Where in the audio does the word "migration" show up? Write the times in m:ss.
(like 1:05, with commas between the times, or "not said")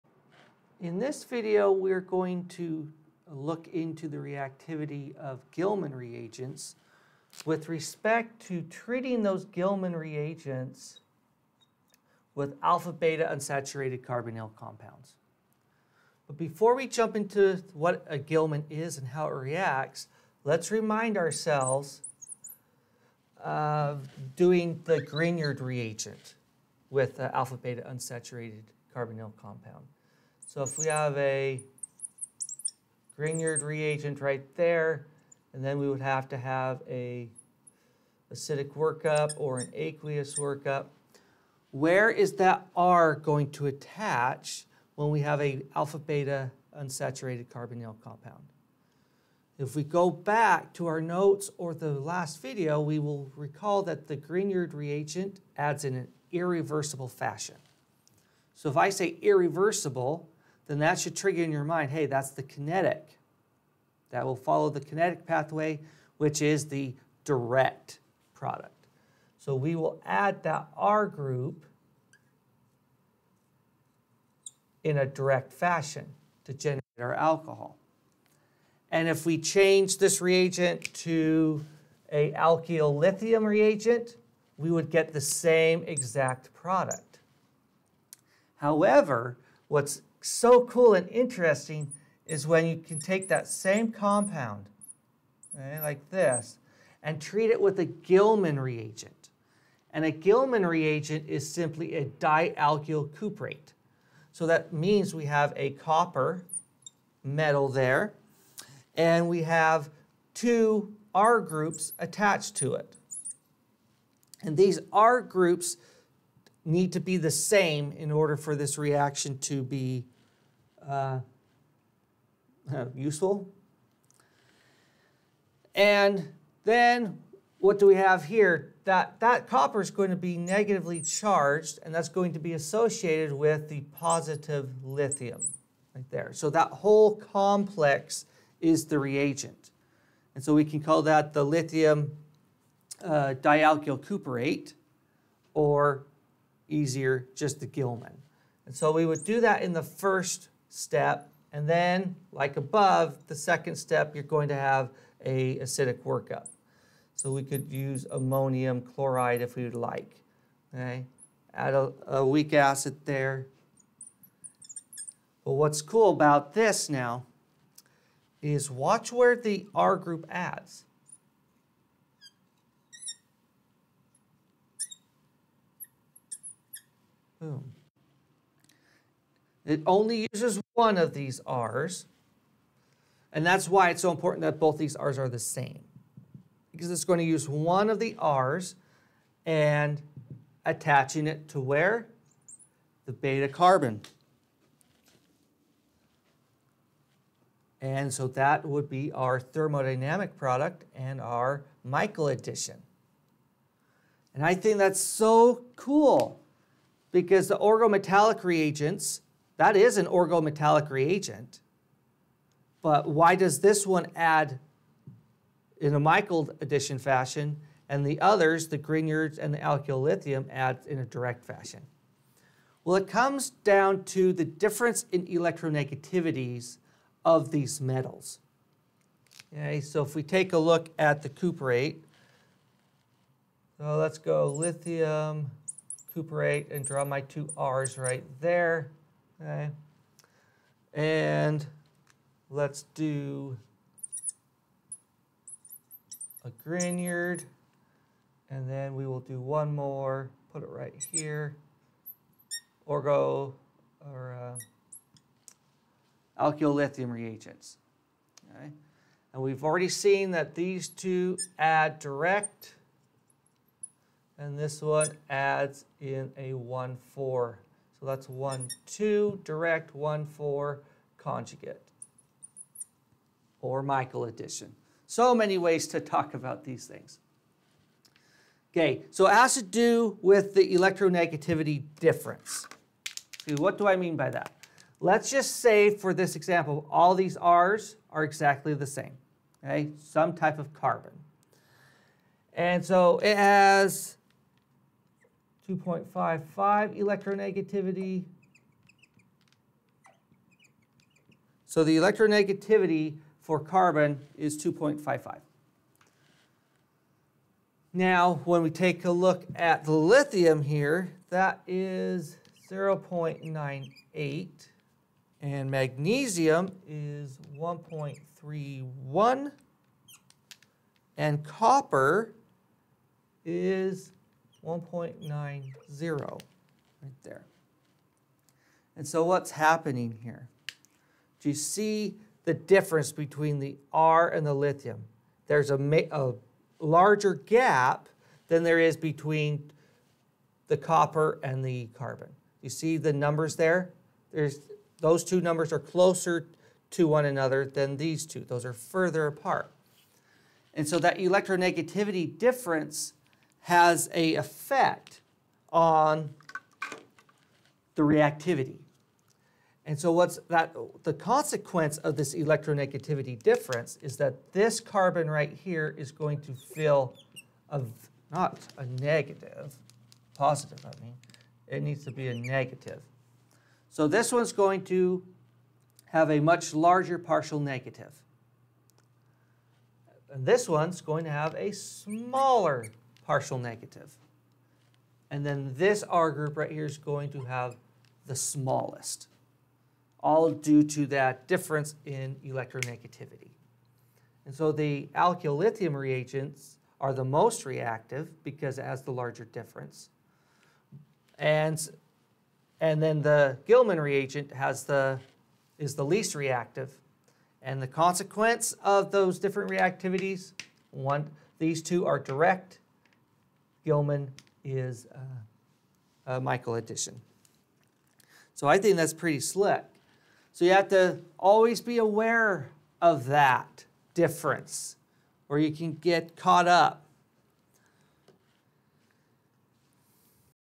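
not said.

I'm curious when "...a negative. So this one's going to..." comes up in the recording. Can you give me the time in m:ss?
6:12.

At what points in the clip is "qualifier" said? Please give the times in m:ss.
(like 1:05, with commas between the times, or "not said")
not said.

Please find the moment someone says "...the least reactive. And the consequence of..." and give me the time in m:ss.
6:45.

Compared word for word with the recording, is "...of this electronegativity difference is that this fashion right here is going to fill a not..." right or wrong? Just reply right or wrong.
wrong.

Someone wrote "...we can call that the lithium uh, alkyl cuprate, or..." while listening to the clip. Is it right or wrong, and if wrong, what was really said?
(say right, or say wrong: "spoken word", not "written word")
wrong: "dialkyl", not "alkyl".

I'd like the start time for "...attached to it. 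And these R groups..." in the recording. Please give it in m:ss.
1:51.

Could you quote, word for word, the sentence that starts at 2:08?
That, that copper is going to be negatively charged, and that's going to be associated with the positive lithium right there.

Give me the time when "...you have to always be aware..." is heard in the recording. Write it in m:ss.
7:00.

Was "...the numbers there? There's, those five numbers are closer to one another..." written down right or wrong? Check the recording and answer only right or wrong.
wrong.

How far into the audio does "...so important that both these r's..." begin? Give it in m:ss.
3:04.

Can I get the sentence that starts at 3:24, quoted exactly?
And I think that's so cool because the organometallic reagents that is an organometallic reagent.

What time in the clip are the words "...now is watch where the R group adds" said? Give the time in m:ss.
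2:46.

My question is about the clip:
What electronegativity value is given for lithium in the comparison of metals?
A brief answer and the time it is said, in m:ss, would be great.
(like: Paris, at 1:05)
0.98, at 5:12.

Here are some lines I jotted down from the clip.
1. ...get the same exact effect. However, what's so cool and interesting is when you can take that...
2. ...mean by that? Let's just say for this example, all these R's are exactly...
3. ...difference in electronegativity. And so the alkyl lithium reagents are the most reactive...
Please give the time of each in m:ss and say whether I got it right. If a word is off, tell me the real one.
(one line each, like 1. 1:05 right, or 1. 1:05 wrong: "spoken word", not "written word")
1. 1:24 wrong: "product", not "effect"
2. 4:43 right
3. 6:31 right.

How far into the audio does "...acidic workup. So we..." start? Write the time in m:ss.
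2:35.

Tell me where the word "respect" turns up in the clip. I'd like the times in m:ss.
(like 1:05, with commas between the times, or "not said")
0:07.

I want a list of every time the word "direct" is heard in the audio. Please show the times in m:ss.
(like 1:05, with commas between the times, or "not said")
1:07, 1:15, 3:41, 4:21, 4:29, 6:52.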